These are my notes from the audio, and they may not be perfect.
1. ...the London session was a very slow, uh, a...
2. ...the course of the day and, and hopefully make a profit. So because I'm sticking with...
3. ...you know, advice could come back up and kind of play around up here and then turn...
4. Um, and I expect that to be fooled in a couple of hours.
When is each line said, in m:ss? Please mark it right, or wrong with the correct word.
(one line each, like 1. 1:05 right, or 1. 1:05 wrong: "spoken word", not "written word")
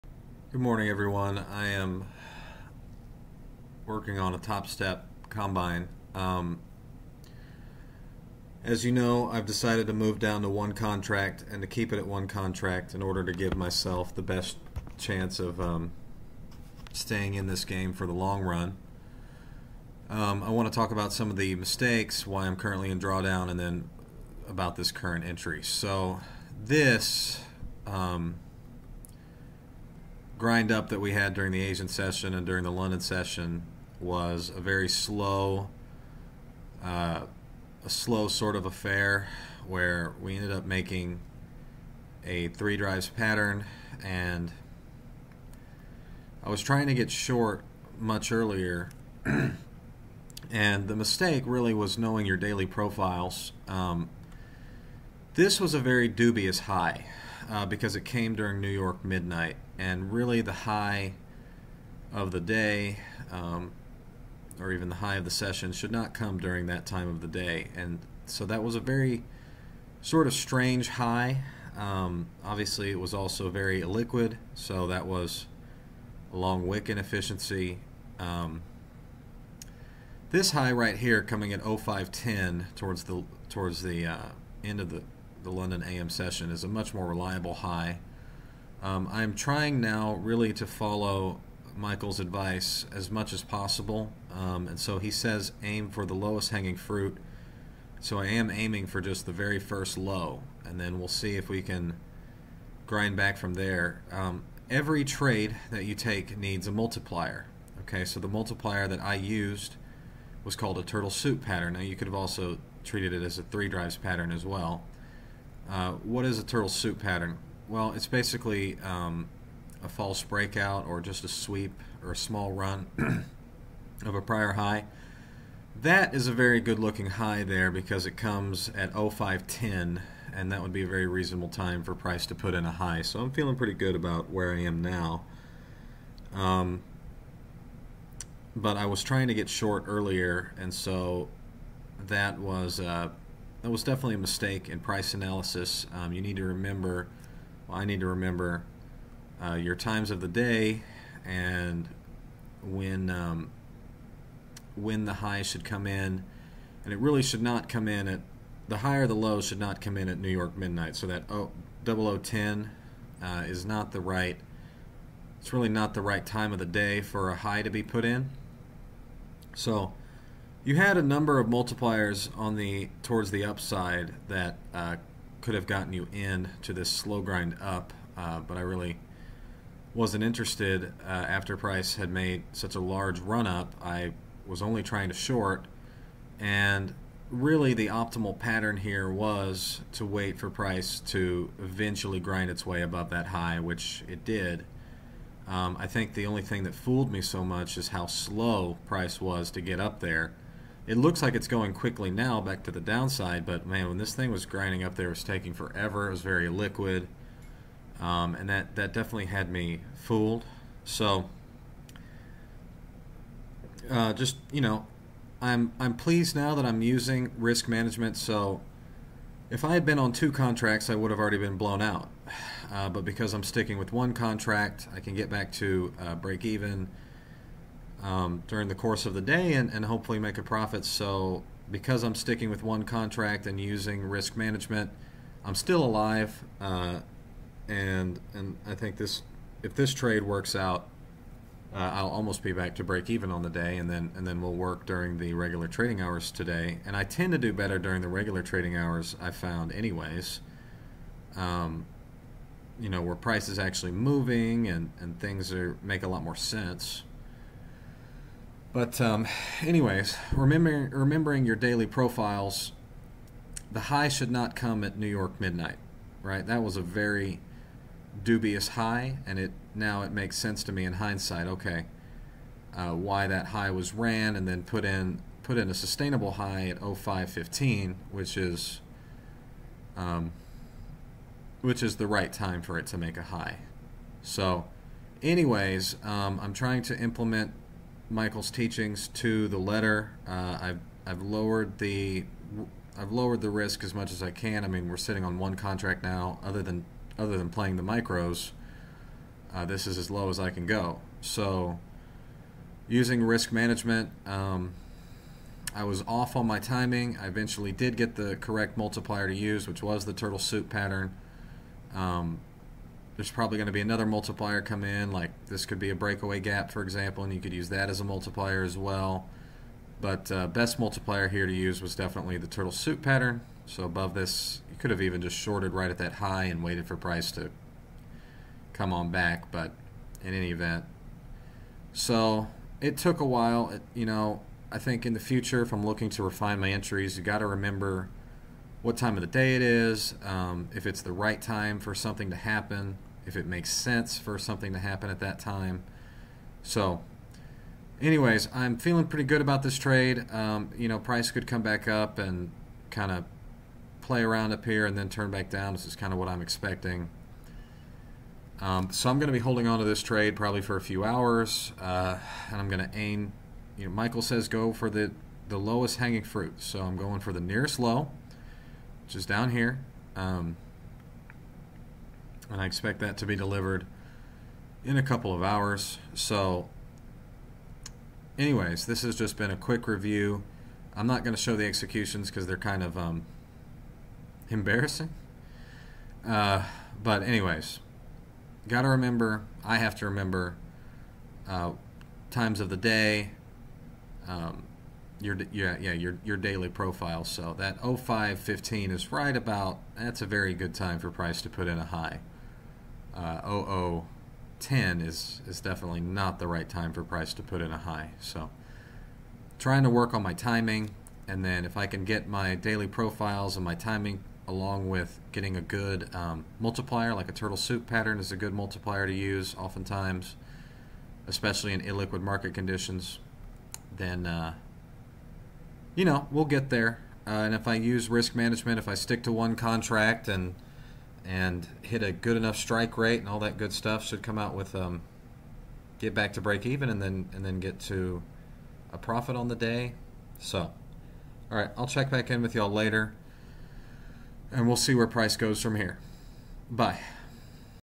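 1. 0:32 right
2. 3:48 right
3. 5:50 wrong: "price", not "advice"
4. 6:10 wrong: "delivered", not "fooled".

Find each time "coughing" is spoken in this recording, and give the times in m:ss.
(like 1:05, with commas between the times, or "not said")
not said.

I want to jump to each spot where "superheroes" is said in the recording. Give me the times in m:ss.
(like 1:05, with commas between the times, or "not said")
not said.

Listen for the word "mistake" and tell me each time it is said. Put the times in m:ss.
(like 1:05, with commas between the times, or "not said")
0:21, 0:50, 2:24.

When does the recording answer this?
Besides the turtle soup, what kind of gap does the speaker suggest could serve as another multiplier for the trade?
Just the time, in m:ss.
5:15.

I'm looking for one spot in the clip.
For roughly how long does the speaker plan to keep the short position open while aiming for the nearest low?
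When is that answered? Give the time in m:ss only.
6:00.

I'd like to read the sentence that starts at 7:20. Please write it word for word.
So, all right, I'll check back in with y'all later, and we'll see where price goes from here.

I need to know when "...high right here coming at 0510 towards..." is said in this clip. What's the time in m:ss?
1:20.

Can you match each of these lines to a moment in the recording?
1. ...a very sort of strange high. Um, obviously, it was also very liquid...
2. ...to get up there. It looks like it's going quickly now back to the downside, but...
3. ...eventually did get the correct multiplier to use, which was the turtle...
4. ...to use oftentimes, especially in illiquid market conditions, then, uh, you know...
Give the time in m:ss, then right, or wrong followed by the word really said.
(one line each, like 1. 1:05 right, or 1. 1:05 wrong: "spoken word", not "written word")
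1. 1:08 right
2. 3:19 right
3. 5:07 right
4. 6:59 right.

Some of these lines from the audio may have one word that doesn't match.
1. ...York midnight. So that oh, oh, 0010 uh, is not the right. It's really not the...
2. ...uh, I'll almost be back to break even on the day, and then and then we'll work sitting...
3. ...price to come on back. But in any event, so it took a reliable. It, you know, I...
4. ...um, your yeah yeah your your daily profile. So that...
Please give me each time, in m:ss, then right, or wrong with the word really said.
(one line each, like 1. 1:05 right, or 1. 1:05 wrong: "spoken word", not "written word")
1. 2:40 right
2. 4:01 wrong: "during", not "sitting"
3. 5:26 wrong: "while", not "reliable"
4. 6:34 right.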